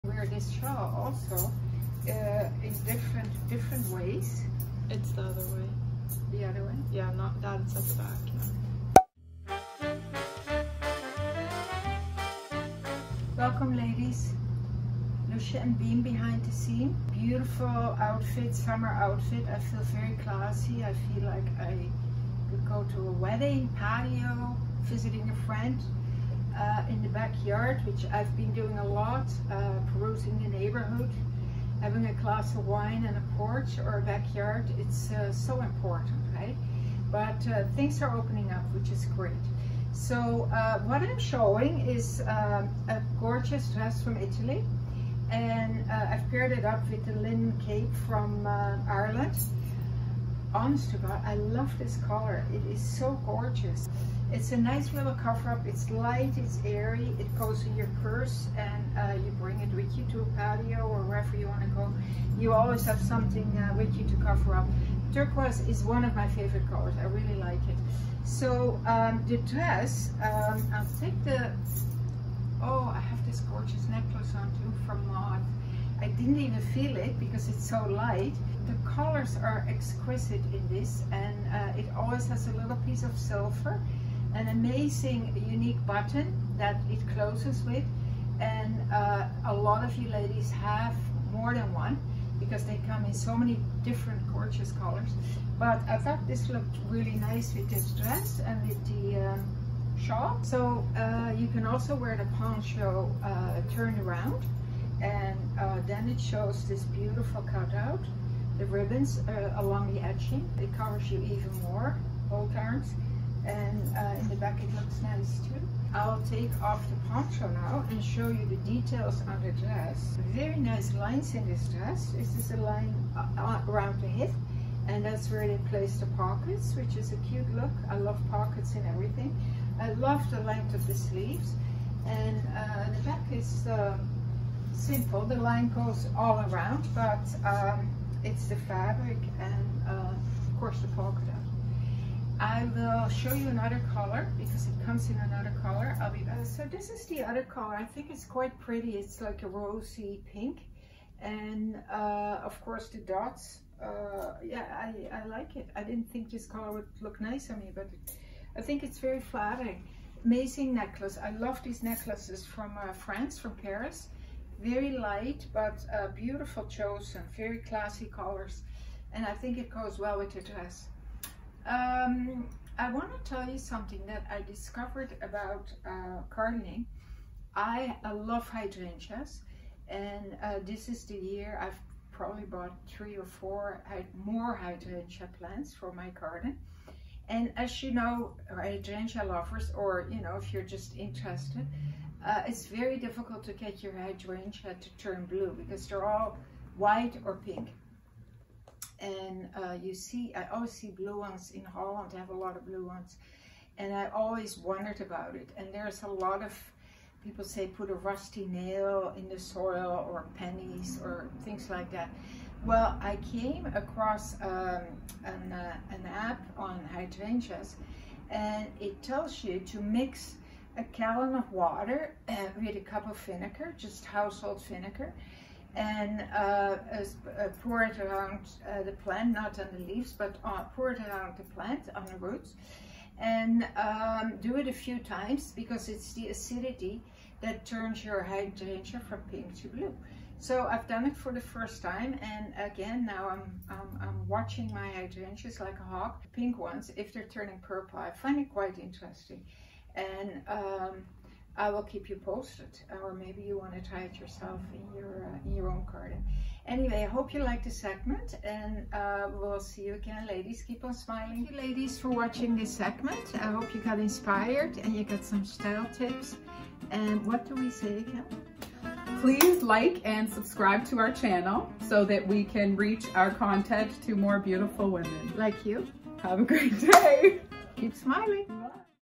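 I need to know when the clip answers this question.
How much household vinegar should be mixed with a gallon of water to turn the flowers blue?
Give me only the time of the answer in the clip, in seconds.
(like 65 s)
222 s.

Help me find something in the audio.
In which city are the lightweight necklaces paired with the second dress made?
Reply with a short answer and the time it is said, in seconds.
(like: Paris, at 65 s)
Paris, at 163 s.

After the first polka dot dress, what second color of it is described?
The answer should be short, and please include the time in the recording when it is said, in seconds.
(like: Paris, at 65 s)
rosy pink, at 149 s.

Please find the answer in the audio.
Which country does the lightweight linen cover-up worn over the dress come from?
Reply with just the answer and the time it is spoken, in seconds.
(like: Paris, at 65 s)
Ireland, at 48 s.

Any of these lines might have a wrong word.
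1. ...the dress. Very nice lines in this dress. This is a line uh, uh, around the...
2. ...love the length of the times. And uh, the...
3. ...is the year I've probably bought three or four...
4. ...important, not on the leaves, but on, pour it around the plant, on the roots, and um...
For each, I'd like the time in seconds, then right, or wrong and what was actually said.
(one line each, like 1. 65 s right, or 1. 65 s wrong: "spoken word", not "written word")
1. 119 s right
2. 129 s wrong: "sleeves", not "times"
3. 180 s right
4. 228 s wrong: "plant", not "important".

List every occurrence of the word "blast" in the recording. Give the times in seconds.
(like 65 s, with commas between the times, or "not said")
not said.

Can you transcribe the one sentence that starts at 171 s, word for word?
Um, I want to tell you something that I discovered about uh, gardening.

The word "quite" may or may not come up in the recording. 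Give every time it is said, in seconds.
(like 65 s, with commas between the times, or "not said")
148 s, 248 s.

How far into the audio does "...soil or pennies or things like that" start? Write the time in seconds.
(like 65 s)
209 s.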